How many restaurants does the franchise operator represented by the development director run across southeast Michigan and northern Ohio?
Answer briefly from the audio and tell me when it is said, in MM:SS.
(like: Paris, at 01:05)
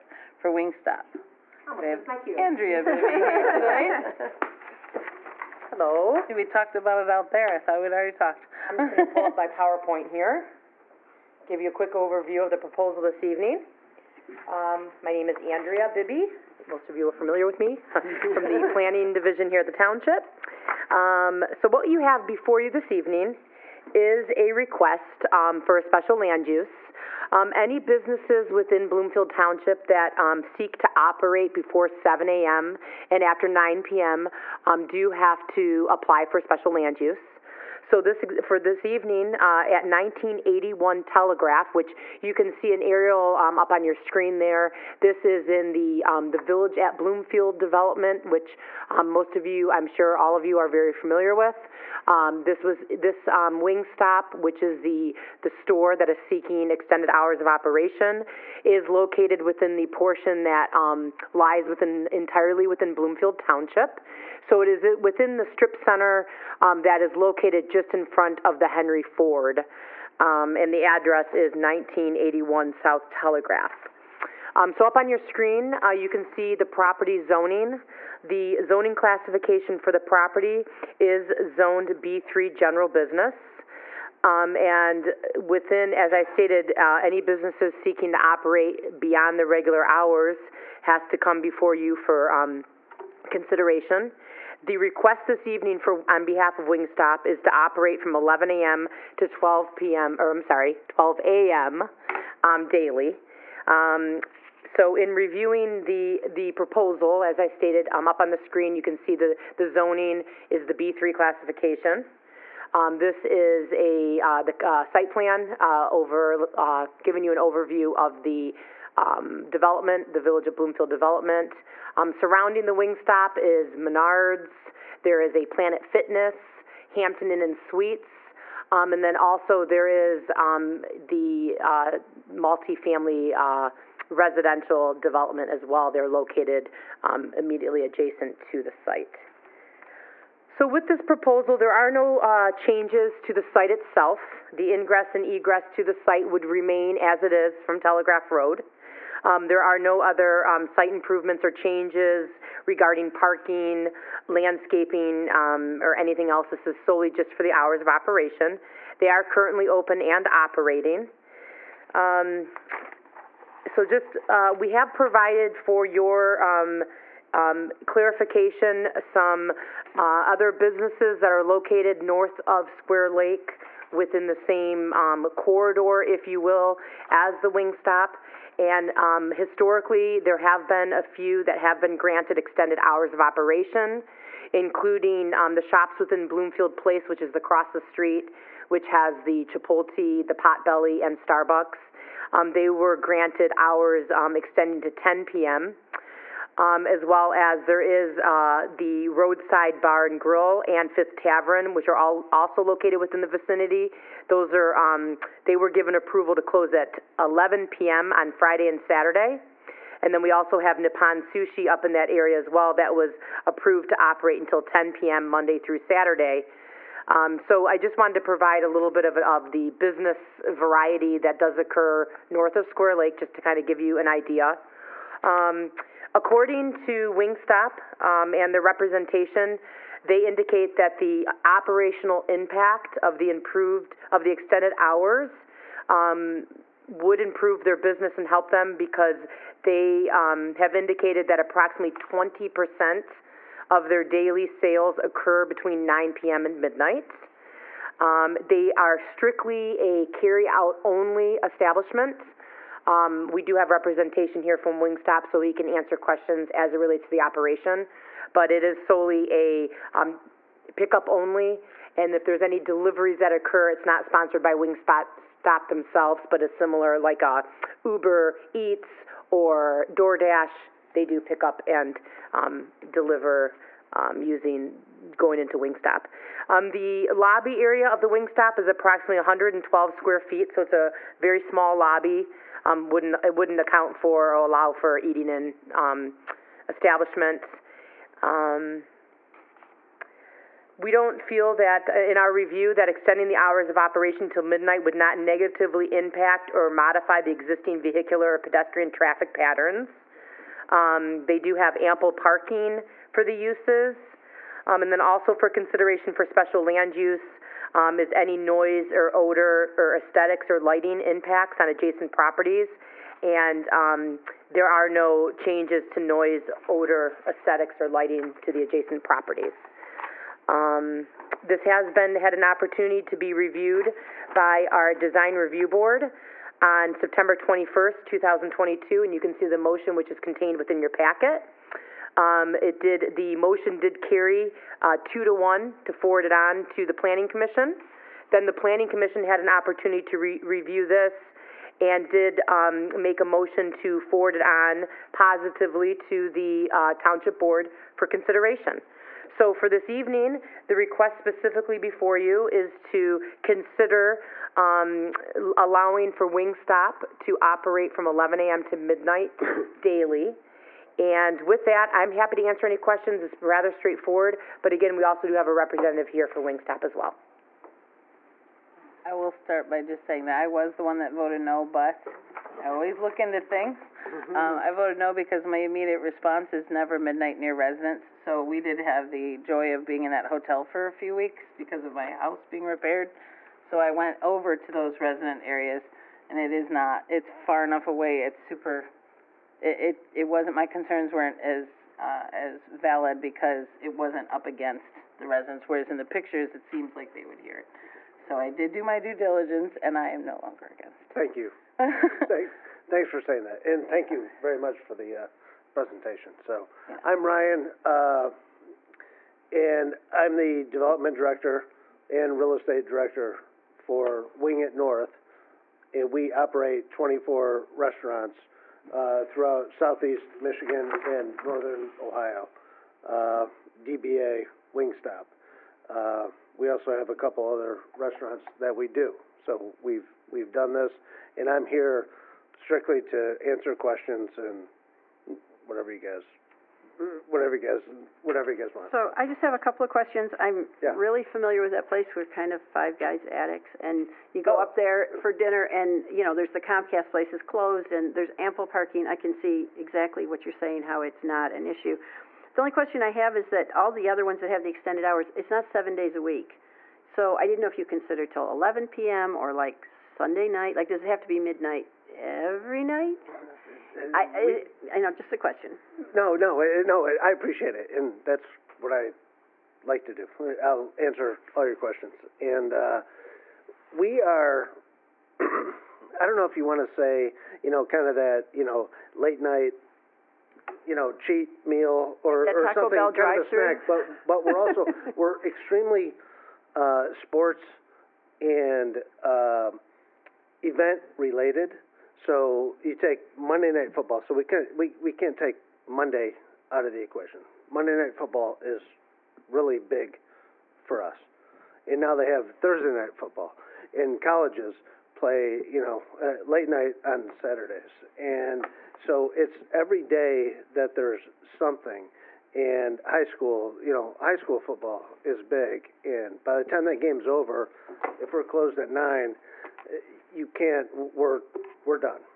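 24, at 06:56.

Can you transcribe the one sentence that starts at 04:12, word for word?
Um, we do have representation here from Wingstop, so he can answer questions as it relates to the operation.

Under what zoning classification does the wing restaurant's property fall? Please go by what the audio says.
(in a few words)
B3 general business.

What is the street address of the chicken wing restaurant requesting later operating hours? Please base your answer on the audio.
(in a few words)
1981 South Telegraph.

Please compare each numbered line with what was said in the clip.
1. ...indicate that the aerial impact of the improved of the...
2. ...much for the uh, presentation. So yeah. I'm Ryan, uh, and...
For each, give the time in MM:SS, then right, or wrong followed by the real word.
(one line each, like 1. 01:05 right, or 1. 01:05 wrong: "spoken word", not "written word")
1. 03:50 wrong: "operational", not "aerial"
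2. 06:44 right.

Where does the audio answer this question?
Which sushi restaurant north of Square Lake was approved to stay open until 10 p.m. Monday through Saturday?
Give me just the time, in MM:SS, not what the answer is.
03:30.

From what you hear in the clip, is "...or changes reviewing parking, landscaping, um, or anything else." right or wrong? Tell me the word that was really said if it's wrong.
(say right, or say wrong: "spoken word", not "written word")
wrong: "regarding", not "reviewing".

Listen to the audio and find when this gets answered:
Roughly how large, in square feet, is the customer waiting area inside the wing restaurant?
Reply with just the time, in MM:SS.
04:39.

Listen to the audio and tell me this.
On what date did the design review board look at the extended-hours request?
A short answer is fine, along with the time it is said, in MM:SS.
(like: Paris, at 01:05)
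September 21st, 2022, at 05:26.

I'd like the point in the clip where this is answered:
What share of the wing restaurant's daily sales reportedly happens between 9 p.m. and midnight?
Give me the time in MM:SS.
04:01.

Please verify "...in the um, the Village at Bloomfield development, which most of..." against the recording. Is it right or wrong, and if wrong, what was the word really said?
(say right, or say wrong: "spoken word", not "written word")
right.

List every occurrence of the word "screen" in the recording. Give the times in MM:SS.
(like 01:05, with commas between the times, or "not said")
00:43, 01:15, 01:48.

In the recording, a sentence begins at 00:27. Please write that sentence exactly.
Um, any businesses within Bloomfield Township that um, seek to operate before 7 a.m.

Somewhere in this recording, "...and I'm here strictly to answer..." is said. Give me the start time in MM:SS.
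07:11.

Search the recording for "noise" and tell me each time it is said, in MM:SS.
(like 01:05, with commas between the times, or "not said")
05:08, 05:15.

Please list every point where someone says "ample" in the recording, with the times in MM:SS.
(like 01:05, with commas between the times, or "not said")
05:01, 07:28.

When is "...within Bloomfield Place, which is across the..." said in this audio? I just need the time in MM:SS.
03:05.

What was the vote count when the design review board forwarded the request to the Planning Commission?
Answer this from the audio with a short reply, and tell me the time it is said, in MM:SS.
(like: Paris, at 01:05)
2 to 1, at 05:35.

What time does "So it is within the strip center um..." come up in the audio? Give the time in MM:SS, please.
01:04.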